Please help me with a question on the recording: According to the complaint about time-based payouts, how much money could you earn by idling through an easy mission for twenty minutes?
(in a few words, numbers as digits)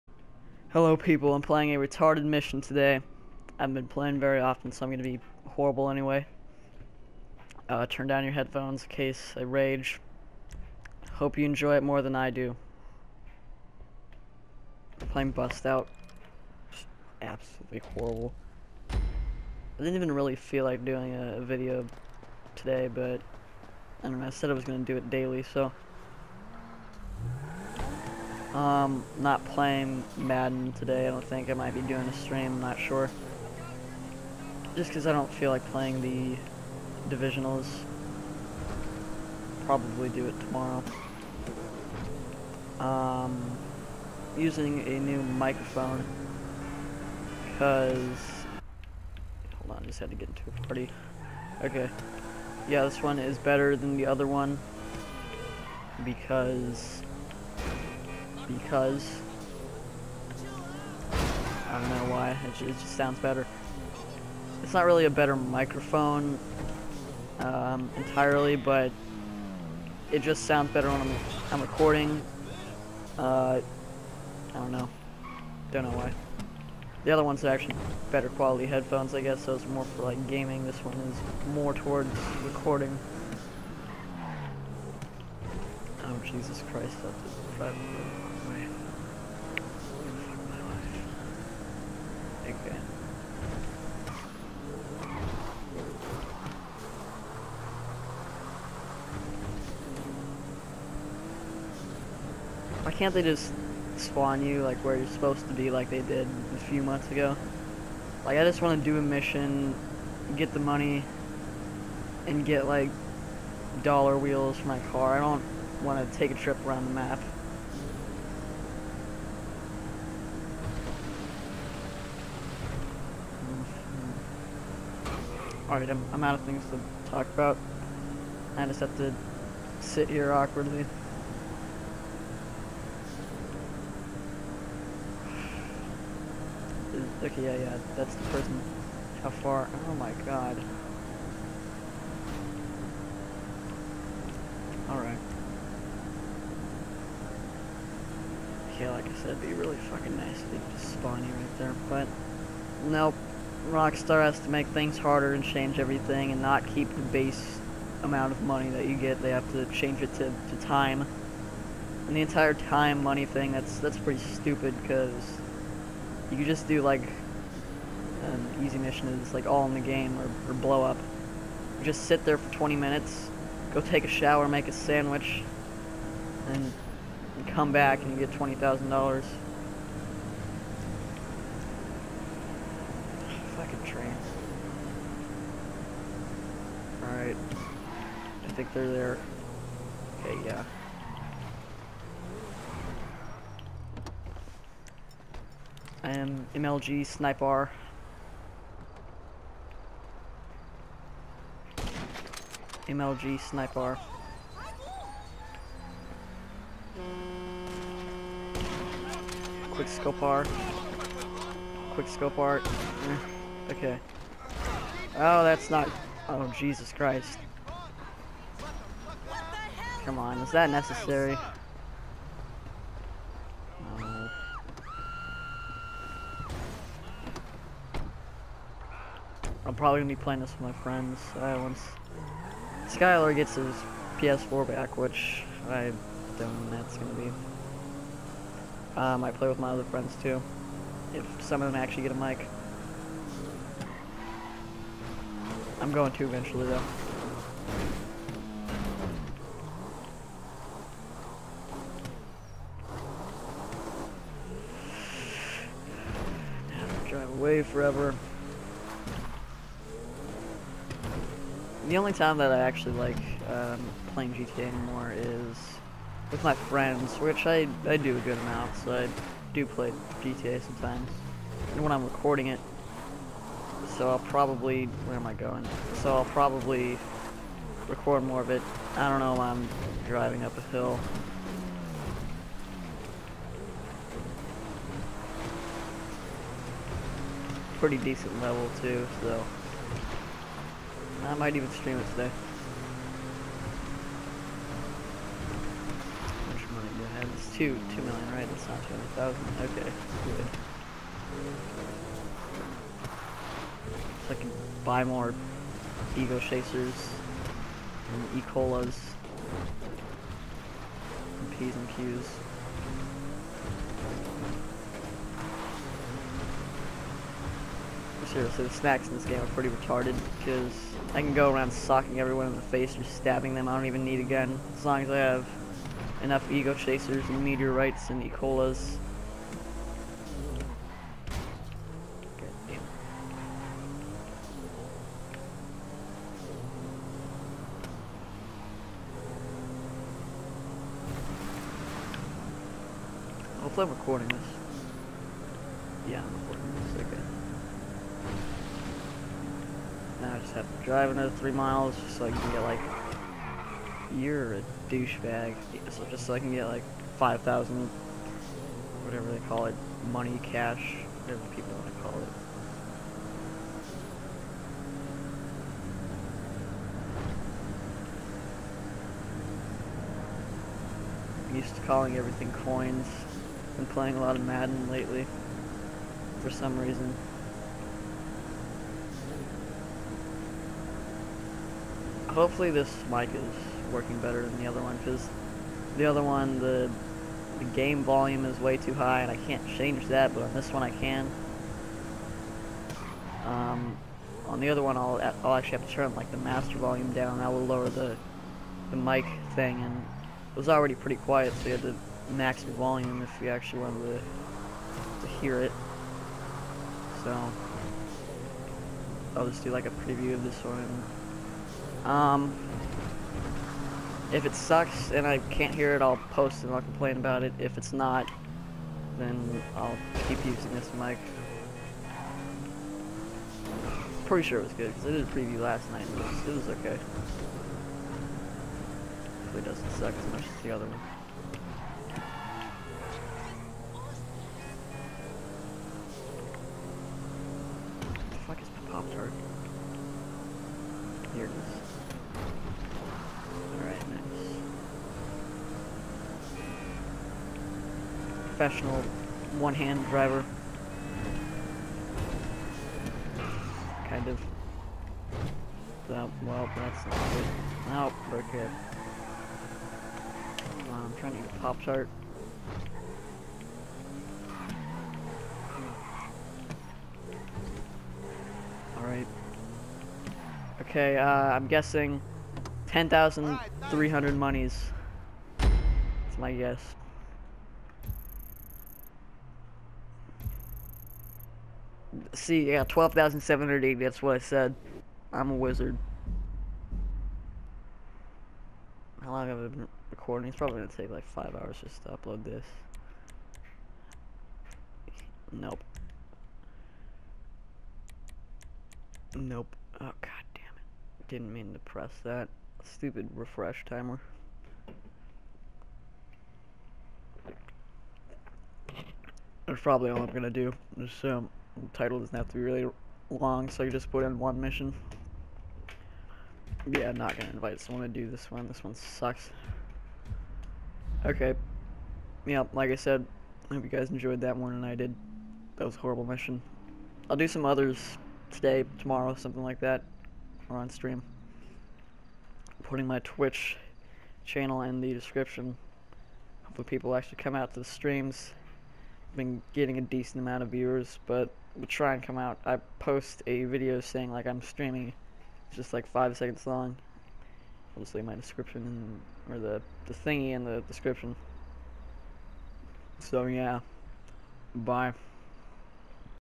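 $20,000.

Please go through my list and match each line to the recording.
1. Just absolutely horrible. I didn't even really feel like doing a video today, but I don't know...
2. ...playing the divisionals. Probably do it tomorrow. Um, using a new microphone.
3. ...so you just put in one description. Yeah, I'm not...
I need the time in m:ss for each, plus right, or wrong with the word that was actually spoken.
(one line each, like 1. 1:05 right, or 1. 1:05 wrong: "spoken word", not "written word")
1. 0:16 right
2. 0:35 right
3. 8:33 wrong: "mission", not "description".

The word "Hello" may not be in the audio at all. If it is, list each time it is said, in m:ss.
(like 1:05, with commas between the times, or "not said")
0:00.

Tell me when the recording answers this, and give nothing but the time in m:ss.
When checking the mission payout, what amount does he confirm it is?
4:57.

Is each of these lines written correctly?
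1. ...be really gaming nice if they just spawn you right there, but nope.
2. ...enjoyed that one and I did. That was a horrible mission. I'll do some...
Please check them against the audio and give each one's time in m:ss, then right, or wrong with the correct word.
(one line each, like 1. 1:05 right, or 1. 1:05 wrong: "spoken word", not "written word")
1. 2:29 wrong: "fucking", not "gaming"
2. 8:44 right.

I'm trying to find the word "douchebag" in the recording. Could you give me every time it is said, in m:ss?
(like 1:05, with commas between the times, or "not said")
5:54.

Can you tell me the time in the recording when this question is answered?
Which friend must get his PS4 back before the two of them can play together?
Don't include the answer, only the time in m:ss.
3:52.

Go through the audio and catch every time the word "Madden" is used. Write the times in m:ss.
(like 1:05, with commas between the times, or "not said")
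0:30, 6:14.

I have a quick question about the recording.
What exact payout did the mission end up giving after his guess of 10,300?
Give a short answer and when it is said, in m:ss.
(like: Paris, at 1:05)
12,780, at 8:02.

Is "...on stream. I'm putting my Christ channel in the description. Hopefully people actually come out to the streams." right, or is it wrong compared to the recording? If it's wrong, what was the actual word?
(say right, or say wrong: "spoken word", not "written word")
wrong: "Twitch", not "Christ".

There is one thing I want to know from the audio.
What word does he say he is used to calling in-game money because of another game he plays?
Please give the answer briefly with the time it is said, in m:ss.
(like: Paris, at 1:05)
coins, at 6:12.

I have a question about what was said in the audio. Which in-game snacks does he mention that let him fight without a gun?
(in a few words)
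Meteorites.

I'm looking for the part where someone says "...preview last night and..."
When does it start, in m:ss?
7:05.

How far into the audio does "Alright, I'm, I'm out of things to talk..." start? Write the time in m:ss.
2:05.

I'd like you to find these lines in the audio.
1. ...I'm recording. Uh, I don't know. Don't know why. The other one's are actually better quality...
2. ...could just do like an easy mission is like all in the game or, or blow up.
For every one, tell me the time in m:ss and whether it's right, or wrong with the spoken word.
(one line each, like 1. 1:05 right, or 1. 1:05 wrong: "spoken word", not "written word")
1. 1:11 right
2. 2:46 right.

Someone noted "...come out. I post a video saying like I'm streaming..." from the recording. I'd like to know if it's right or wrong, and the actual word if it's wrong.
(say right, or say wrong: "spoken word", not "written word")
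right.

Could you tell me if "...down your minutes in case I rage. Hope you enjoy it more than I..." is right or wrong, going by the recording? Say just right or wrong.
wrong.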